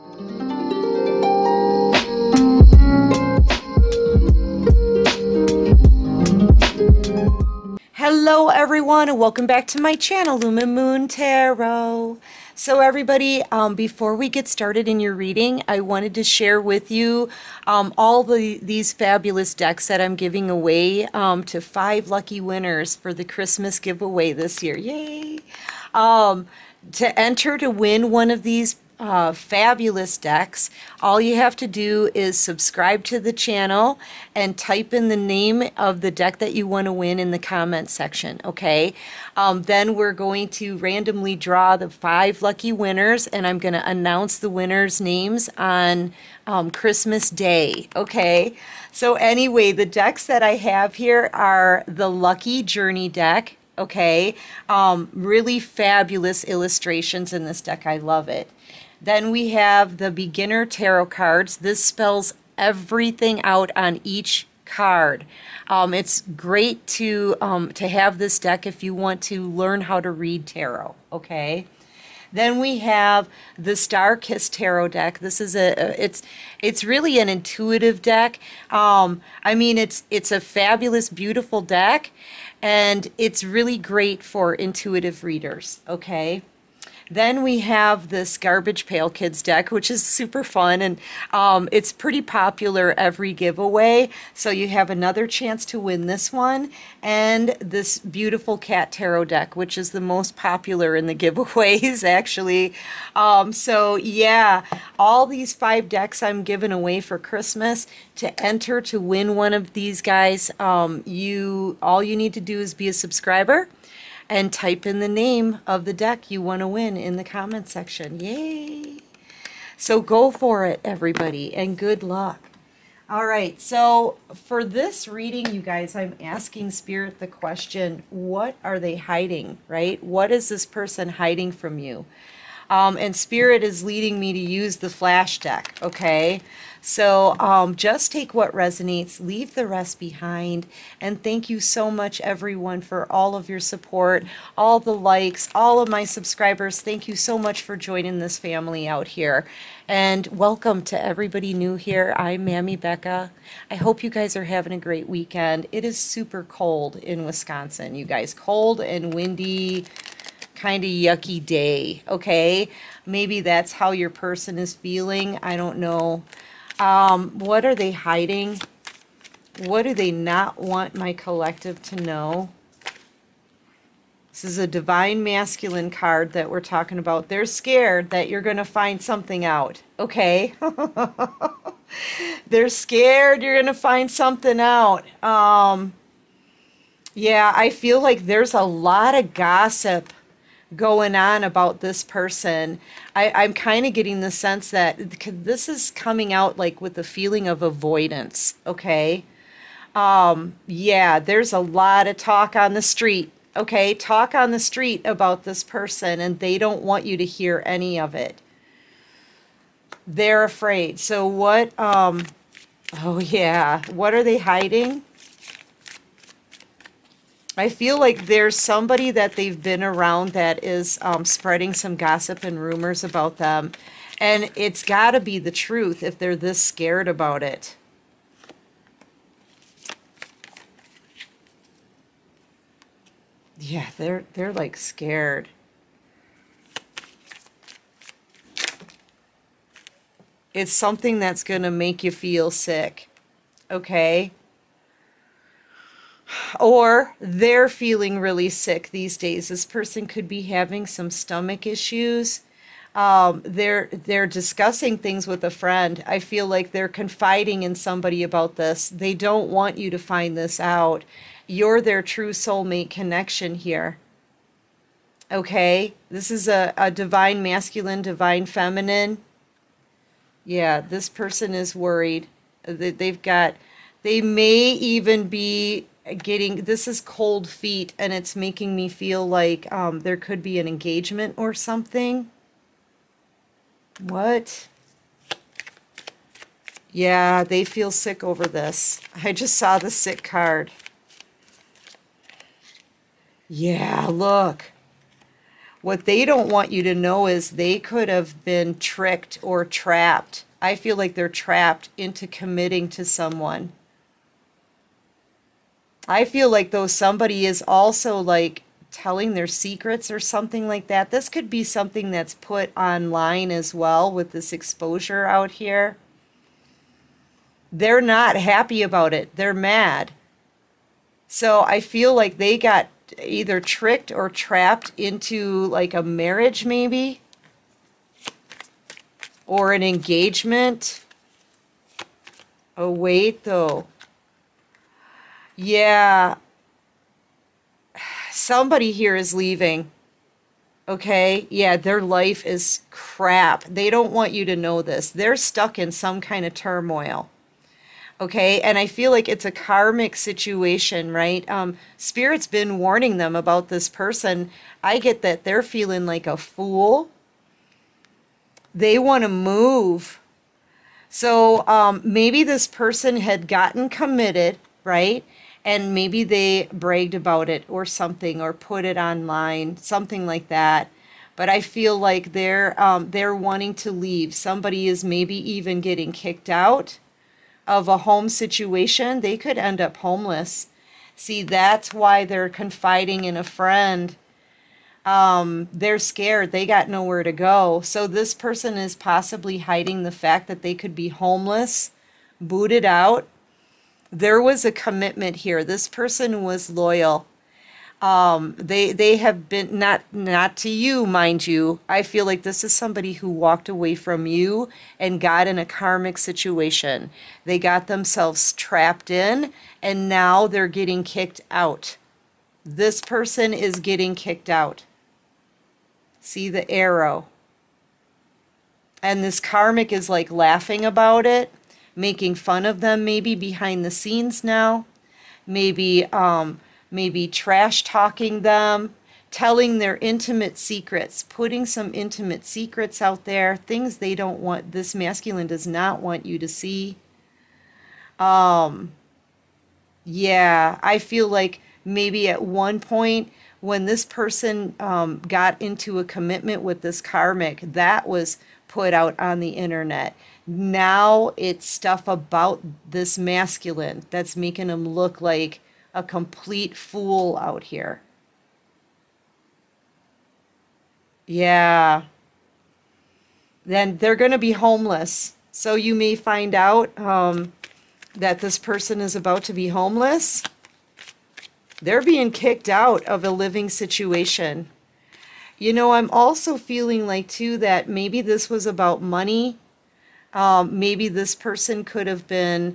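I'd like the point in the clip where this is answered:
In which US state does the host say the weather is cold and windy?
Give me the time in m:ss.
2:37.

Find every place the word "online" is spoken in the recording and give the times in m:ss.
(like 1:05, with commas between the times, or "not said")
5:12, 6:08.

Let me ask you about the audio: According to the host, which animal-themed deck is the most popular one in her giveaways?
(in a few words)
Cat Tarot.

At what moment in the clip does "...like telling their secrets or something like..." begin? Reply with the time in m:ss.
5:08.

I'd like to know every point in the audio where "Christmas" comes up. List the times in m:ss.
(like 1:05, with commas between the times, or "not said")
0:23, 0:46, 1:47.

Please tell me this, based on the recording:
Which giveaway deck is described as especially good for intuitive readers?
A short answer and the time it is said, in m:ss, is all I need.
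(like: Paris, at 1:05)
Star Kiss Tarot, at 1:13.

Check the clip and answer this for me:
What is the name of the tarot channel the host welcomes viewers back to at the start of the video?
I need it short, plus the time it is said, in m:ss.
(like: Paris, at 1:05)
Lumen Moon Tarot, at 0:10.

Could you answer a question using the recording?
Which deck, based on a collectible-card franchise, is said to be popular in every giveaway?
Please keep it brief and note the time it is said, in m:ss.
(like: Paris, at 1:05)
Garbage Pail Kids, at 1:28.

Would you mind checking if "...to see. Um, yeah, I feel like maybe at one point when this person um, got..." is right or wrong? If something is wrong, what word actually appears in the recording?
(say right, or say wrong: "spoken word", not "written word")
right.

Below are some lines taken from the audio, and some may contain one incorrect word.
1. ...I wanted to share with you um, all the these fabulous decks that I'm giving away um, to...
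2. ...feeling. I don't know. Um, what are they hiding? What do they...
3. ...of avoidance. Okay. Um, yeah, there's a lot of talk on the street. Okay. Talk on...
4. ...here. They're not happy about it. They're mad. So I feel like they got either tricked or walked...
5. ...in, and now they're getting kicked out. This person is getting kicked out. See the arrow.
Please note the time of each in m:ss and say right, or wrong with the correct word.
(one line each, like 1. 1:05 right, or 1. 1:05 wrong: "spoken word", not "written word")
1. 0:15 right
2. 2:44 right
3. 3:17 right
4. 5:15 wrong: "trapped", not "walked"
5. 6:49 right.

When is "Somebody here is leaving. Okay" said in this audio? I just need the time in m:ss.
5:38.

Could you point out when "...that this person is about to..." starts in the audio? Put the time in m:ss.
7:48.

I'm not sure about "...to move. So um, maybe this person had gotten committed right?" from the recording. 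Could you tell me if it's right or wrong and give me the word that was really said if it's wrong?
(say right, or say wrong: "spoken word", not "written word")
right.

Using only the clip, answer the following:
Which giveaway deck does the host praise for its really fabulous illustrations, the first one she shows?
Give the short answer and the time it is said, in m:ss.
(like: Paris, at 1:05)
Lucky Journey, at 0:52.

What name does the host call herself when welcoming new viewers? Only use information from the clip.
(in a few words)
Mammy Becca.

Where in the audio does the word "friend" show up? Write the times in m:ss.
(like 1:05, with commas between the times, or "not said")
4:15, 6:23.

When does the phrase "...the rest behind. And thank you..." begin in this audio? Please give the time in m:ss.
2:19.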